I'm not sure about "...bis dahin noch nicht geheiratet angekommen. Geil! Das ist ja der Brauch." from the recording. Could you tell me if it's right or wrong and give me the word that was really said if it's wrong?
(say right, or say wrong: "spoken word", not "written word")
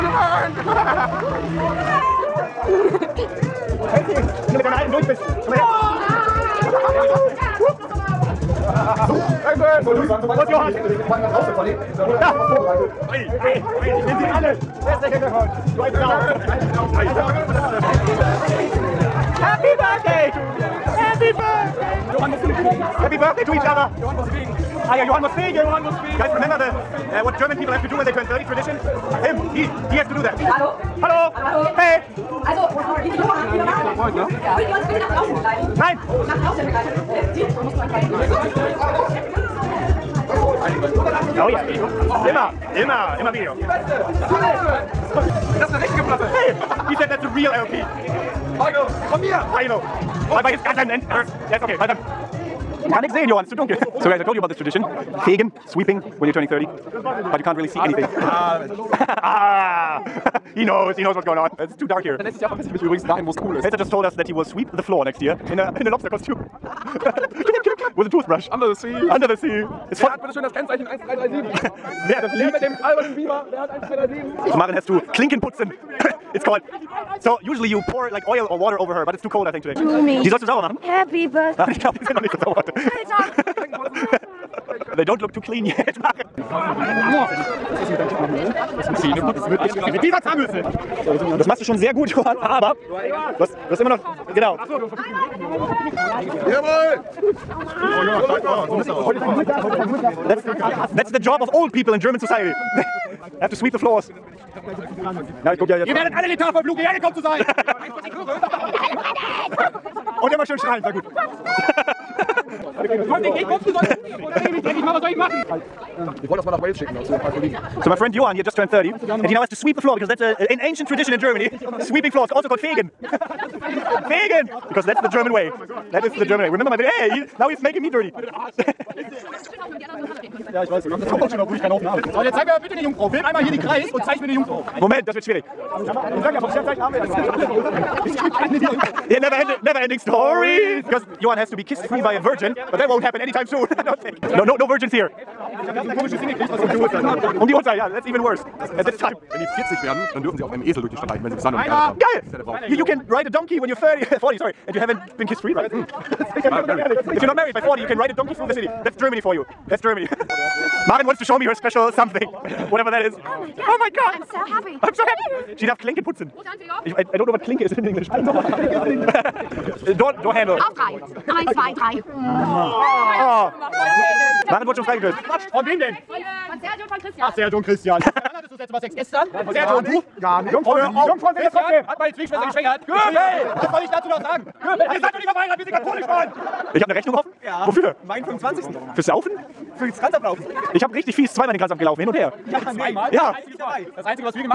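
wrong: "haben", not "angekommen".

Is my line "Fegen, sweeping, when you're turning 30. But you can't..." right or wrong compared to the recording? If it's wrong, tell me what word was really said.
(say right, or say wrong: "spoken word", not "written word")
right.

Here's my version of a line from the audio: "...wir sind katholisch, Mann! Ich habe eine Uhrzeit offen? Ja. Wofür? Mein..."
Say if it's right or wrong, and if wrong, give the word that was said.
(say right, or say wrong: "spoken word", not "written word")
wrong: "Rechnung", not "Uhrzeit".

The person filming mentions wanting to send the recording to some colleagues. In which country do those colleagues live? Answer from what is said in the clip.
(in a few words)
Wales.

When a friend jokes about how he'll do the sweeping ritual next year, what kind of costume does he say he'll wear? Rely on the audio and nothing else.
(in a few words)
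Lobster costume.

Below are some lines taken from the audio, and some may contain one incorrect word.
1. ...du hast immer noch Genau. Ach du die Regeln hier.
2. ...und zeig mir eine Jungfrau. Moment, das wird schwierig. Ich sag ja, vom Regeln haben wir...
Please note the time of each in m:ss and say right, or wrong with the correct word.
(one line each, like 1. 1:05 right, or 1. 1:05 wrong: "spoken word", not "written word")
1. 1:33 right
2. 2:13 wrong: "Sternzeichen", not "Regeln".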